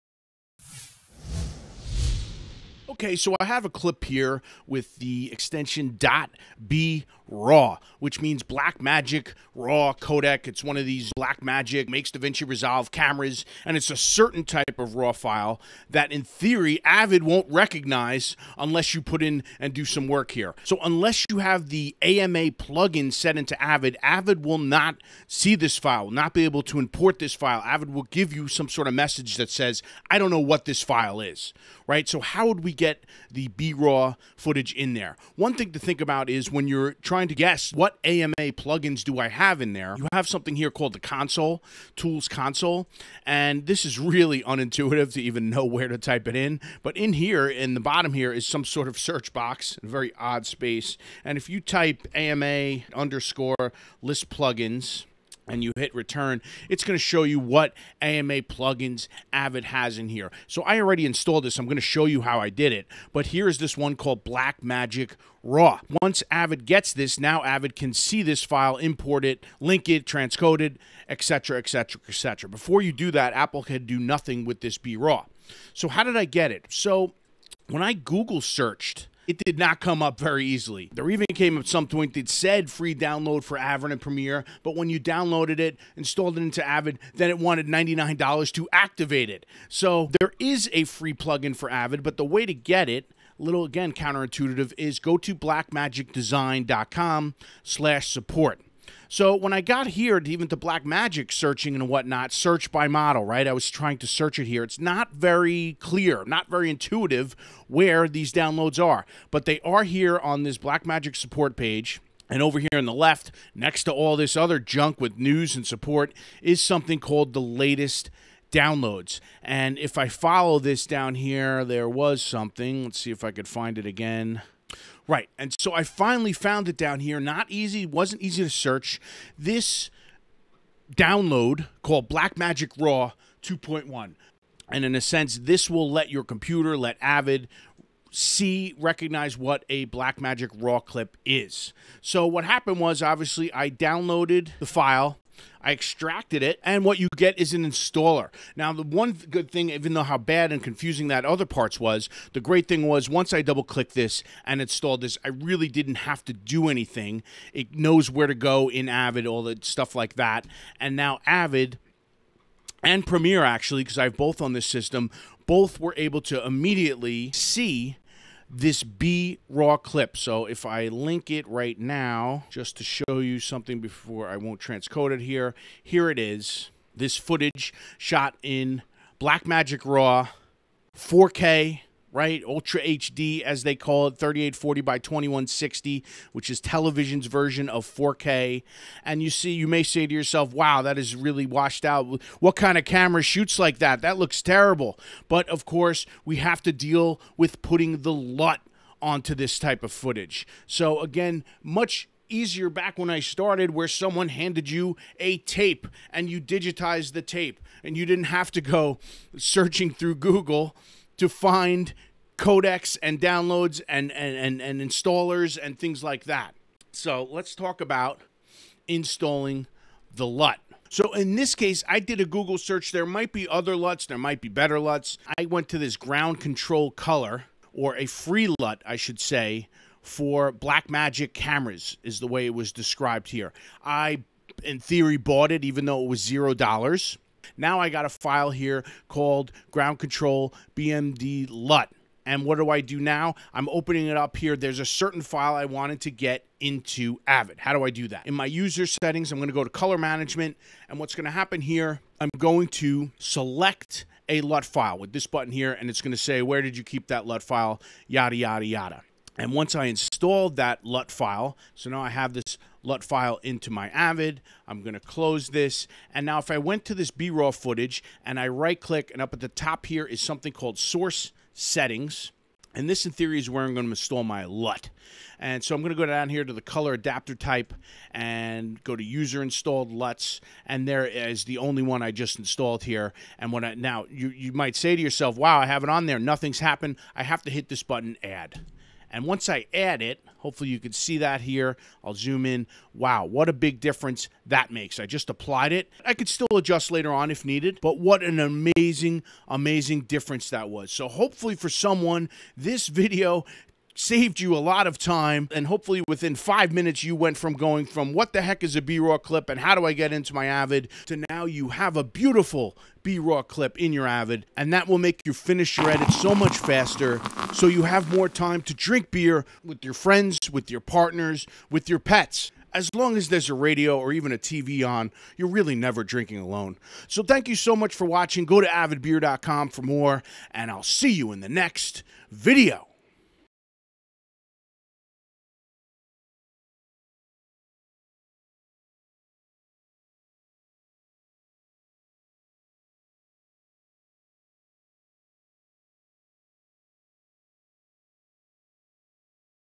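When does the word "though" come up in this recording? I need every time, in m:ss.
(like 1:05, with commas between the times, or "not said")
2:29, 3:55.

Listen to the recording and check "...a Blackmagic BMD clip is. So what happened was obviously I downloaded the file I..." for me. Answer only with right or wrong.
wrong.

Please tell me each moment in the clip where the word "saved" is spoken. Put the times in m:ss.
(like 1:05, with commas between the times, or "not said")
5:03.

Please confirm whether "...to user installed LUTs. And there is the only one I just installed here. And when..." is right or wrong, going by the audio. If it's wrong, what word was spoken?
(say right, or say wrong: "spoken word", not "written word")
right.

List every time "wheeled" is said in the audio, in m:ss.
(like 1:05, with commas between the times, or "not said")
not said.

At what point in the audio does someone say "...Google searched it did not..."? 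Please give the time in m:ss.
1:17.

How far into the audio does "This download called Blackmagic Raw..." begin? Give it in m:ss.
2:09.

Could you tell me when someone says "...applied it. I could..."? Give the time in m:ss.
4:55.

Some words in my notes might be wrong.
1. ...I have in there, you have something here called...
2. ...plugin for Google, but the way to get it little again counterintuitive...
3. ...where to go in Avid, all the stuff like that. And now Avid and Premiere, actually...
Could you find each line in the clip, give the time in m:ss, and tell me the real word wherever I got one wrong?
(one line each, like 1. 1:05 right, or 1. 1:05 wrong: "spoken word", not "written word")
1. 0:39 right
2. 1:31 wrong: "Avid", not "Google"
3. 2:38 right.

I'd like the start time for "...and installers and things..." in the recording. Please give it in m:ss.
3:34.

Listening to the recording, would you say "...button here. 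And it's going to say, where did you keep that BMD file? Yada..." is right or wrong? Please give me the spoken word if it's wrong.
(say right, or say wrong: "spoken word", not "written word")
wrong: "LUT", not "BMD".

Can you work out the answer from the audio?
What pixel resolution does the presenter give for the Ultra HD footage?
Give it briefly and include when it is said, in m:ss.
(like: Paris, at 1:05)
3840 by 2160, at 3:04.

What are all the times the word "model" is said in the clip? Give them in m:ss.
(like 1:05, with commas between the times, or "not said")
1:42.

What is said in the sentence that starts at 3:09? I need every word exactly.
And you see, you may say to yourself, wow, that is really washed out.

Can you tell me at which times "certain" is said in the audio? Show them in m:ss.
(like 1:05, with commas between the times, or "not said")
0:13, 4:04.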